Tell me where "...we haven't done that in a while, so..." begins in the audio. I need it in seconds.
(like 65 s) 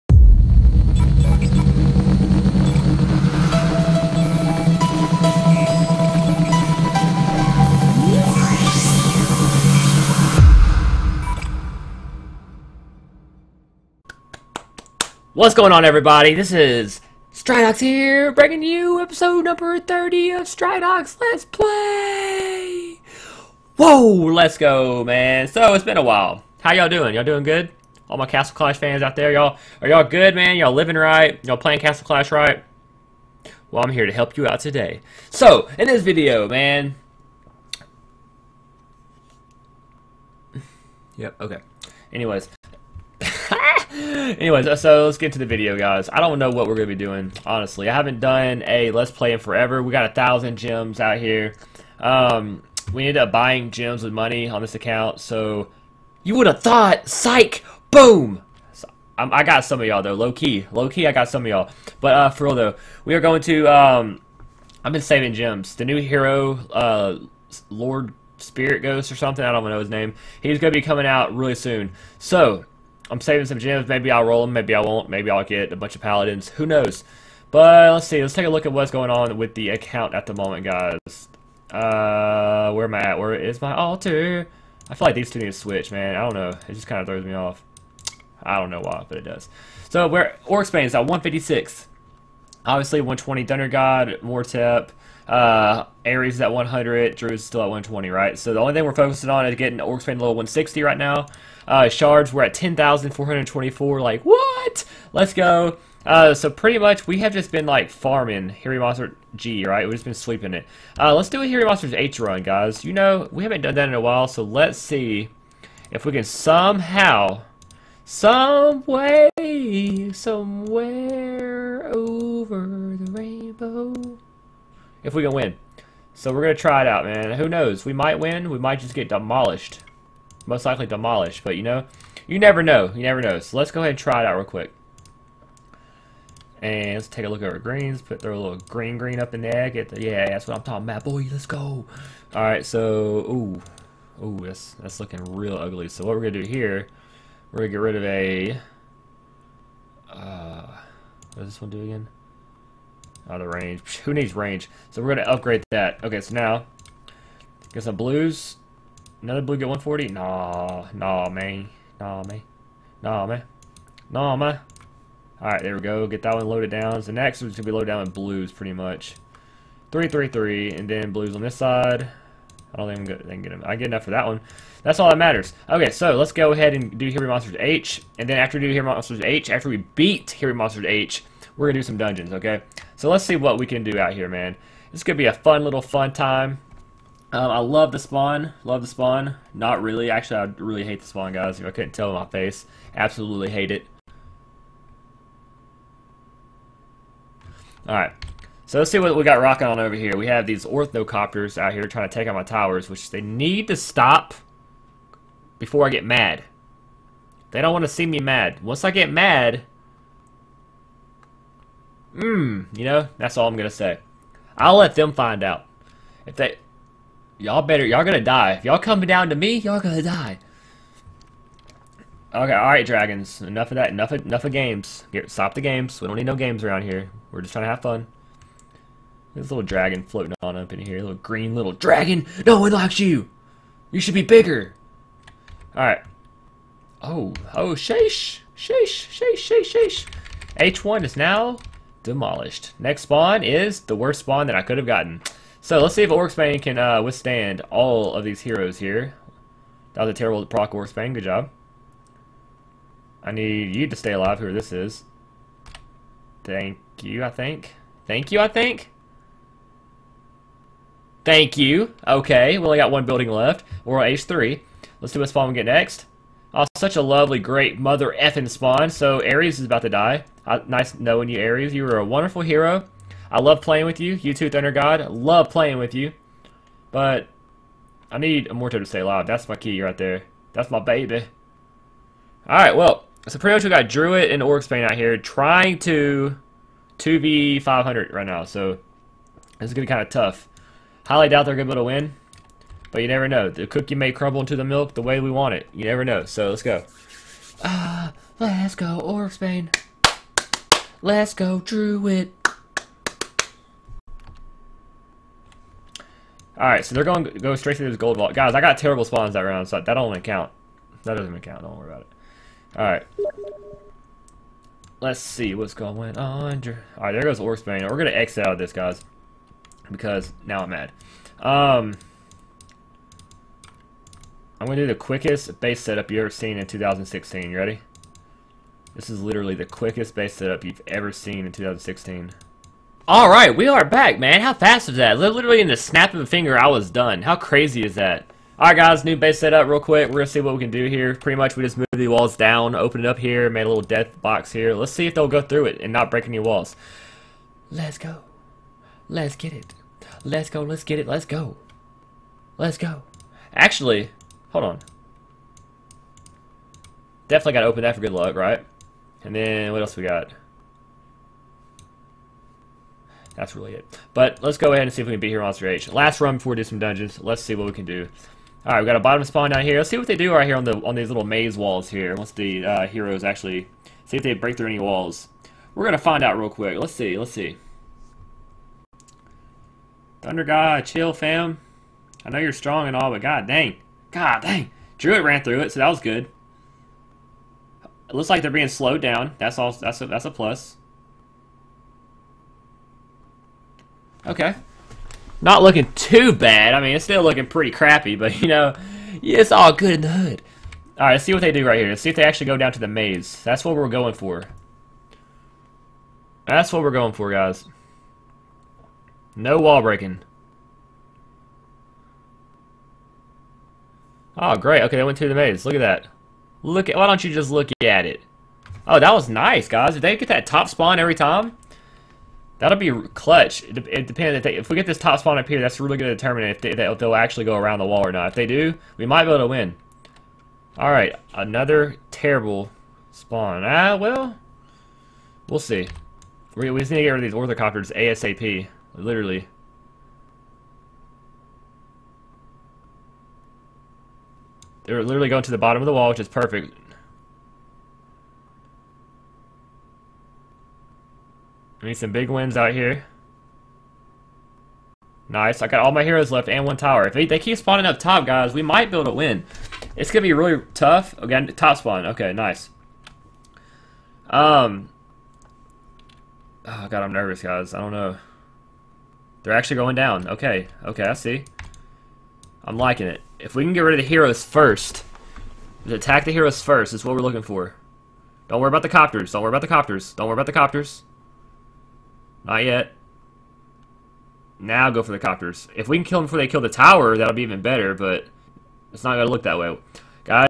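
113 s.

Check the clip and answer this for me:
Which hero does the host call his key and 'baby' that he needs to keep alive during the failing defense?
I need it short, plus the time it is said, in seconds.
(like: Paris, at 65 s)
Morto, at 278 s.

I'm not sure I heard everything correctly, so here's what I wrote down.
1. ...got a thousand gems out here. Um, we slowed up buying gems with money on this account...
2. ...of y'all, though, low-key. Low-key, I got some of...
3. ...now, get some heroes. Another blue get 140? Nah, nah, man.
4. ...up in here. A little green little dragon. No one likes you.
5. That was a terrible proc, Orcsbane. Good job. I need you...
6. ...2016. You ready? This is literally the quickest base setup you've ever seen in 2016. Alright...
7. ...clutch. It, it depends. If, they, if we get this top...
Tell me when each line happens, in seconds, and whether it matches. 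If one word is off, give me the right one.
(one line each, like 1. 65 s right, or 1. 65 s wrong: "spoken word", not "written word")
1. 49 s wrong: "ended", not "slowed"
2. 59 s right
3. 156 s wrong: "blues", not "heroes"
4. 230 s right
5. 249 s right
6. 326 s right
7. 423 s right.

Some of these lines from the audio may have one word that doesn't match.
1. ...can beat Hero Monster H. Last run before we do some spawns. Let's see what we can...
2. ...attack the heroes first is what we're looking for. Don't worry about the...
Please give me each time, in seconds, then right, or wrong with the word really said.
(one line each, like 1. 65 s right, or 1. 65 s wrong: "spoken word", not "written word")
1. 365 s wrong: "dungeons", not "spawns"
2. 475 s right.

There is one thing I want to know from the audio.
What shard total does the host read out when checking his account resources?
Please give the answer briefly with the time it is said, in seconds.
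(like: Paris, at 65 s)
10,424, at 102 s.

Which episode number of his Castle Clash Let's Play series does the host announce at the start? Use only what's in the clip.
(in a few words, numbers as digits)
30.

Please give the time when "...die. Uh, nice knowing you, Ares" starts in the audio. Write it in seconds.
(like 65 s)
269 s.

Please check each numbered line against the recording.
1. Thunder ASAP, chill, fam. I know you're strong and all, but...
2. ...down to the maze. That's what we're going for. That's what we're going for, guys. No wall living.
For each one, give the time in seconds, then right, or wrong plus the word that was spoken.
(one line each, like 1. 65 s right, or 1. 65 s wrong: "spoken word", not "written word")
1. 380 s wrong: "God", not "ASAP"
2. 402 s wrong: "breaking", not "living".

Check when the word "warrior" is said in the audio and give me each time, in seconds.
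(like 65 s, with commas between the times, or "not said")
not said.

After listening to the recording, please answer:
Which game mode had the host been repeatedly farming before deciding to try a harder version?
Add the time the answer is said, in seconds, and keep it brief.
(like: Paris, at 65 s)
Hero Monster G, at 108 s.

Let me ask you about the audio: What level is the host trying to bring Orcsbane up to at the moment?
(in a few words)
160.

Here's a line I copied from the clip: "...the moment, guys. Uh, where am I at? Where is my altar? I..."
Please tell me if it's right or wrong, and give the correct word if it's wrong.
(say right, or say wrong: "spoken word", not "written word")
right.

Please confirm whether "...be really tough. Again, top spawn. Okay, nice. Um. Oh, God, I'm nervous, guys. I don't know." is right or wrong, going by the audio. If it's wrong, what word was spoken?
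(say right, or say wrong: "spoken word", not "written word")
right.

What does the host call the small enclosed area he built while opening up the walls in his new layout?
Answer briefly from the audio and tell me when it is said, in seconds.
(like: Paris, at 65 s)
death box, at 343 s.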